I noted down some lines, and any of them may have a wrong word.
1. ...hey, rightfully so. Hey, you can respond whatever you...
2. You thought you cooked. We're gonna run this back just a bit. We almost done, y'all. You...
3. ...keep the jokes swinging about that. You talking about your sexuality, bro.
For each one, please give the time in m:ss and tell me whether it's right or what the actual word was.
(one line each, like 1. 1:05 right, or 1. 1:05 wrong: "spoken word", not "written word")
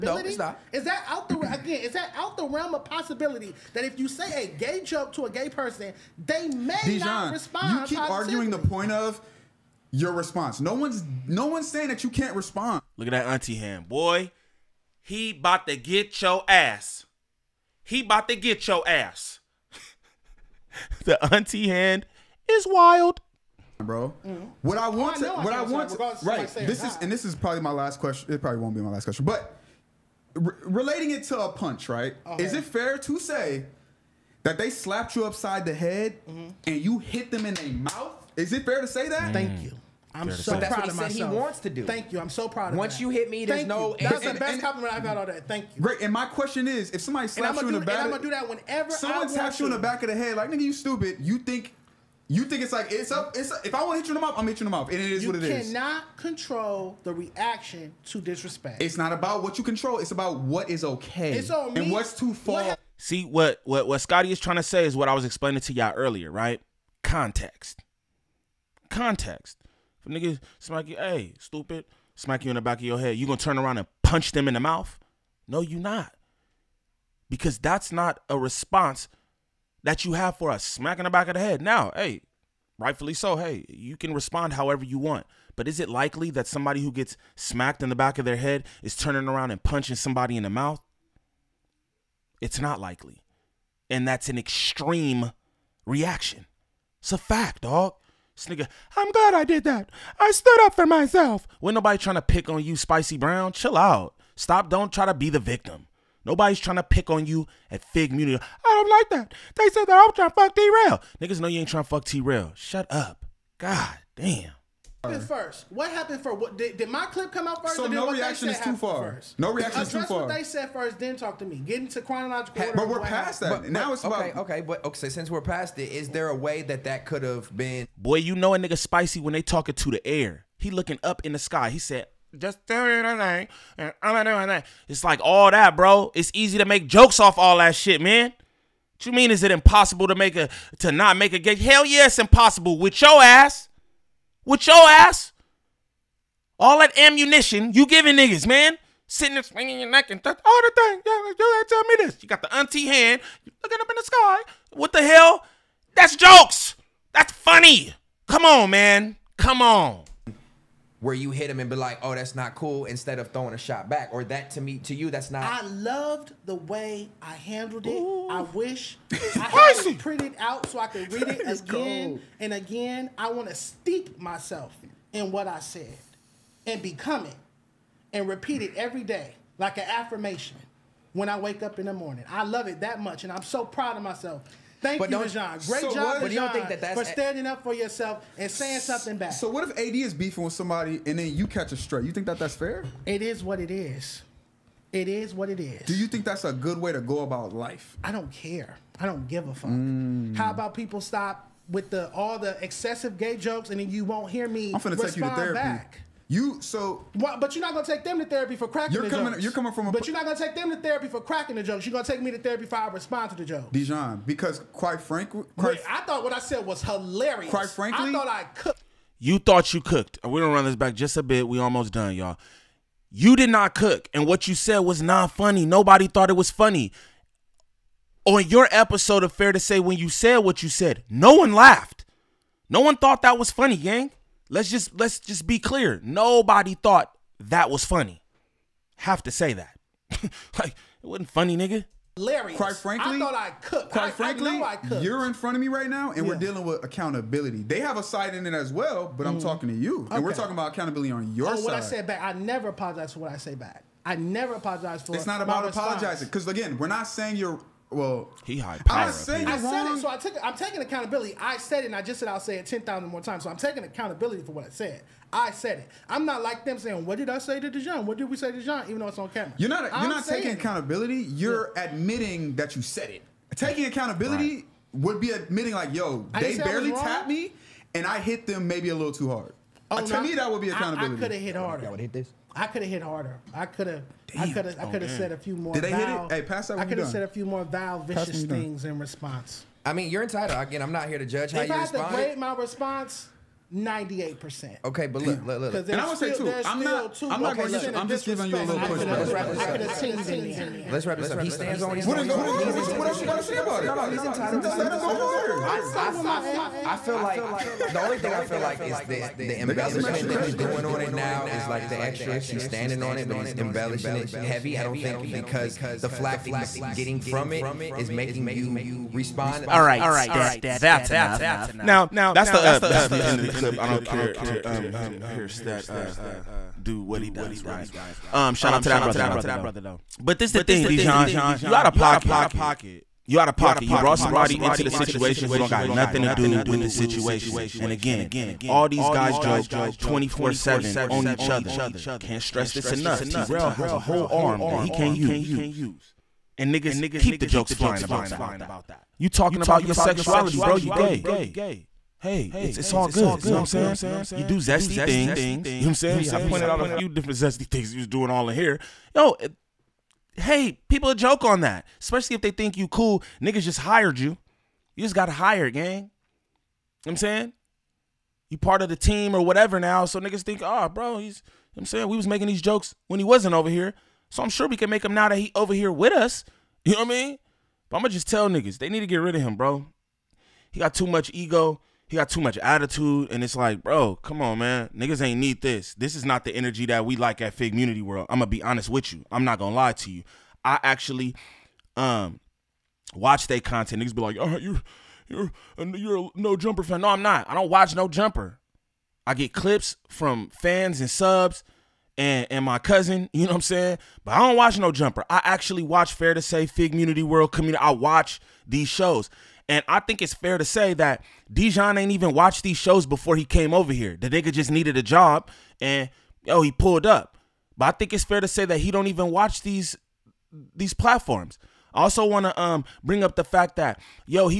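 1. 1:21 wrong: "however", not "whatever"
2. 3:39 right
3. 5:47 wrong: "flying", not "swinging".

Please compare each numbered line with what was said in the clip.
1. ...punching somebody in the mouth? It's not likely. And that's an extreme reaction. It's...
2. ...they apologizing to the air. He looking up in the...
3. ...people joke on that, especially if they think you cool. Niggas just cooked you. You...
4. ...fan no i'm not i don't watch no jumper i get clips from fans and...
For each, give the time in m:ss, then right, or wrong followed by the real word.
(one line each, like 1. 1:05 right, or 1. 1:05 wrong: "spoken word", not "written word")
1. 1:29 right
2. 2:09 wrong: "talking", not "apologizing"
3. 6:00 wrong: "hired", not "cooked"
4. 6:36 right.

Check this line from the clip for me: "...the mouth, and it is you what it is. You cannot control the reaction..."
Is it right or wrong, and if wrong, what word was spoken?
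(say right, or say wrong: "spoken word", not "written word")
right.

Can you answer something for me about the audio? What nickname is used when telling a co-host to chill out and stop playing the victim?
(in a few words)
Spicy Brown.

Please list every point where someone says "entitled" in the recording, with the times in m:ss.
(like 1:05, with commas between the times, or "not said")
4:50, 5:04.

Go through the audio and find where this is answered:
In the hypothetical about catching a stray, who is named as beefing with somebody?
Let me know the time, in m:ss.
3:09.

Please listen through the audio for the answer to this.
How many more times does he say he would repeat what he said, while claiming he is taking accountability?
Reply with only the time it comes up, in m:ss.
4:22.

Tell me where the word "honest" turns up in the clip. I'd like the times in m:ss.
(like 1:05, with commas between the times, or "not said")
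6:28.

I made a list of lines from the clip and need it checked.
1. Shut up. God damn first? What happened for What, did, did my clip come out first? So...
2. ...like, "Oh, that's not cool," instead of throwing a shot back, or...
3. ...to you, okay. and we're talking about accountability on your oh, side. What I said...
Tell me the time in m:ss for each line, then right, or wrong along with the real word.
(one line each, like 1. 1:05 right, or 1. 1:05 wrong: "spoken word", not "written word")
1. 1:52 right
2. 2:41 right
3. 4:09 right.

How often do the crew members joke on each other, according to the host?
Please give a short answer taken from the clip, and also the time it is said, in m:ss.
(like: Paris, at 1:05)
24-7, at 5:40.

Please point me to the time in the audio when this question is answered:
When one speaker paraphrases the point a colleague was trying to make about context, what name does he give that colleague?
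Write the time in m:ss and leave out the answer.
1:04.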